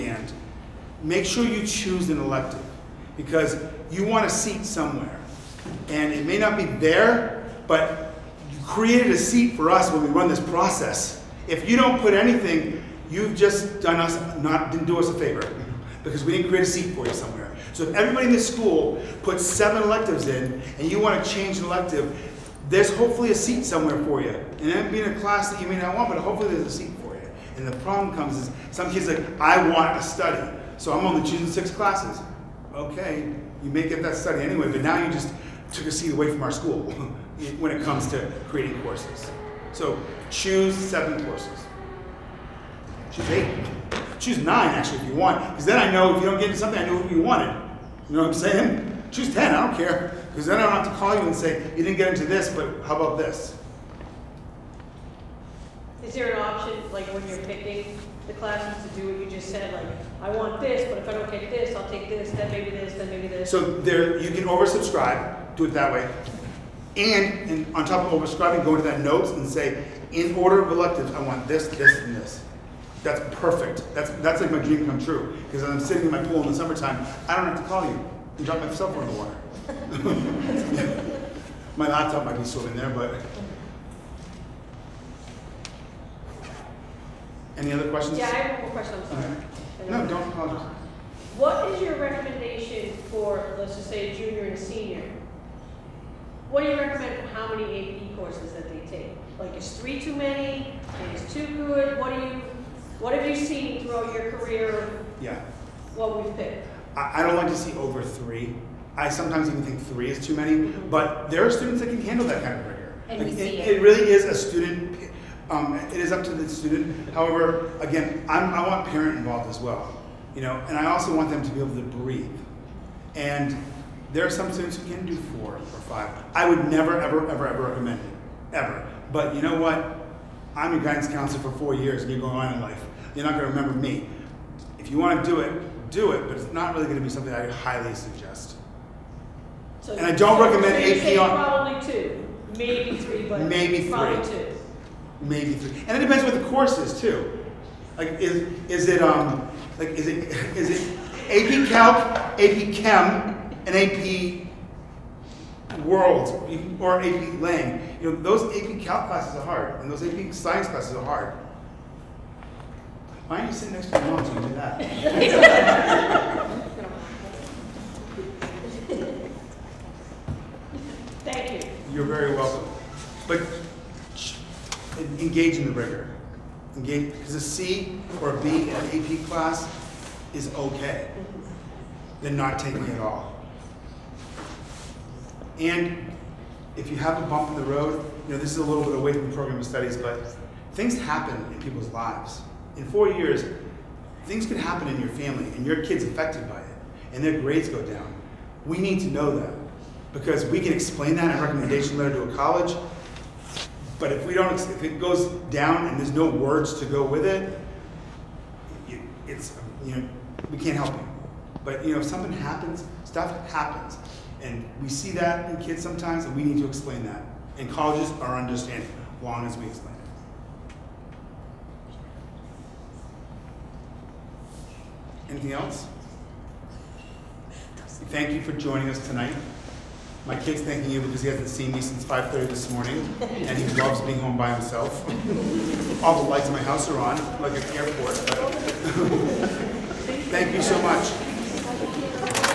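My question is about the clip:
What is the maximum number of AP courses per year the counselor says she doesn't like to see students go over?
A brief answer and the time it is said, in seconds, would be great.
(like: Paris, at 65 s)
3, at 107 s.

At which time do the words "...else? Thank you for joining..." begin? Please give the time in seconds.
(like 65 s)
225 s.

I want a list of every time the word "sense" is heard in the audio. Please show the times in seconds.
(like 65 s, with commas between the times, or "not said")
not said.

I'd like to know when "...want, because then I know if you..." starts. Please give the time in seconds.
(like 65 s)
45 s.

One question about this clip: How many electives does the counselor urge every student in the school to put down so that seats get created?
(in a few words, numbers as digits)
7.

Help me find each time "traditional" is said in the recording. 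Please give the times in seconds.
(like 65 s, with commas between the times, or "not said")
not said.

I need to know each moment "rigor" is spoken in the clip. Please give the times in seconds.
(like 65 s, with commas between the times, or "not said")
112 s, 175 s.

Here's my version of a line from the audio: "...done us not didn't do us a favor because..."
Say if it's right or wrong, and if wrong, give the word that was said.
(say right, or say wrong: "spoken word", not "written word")
right.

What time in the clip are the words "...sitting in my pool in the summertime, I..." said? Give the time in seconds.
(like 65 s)
75 s.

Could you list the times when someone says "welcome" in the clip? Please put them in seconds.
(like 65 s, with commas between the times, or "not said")
172 s.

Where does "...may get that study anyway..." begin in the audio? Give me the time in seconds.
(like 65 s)
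33 s.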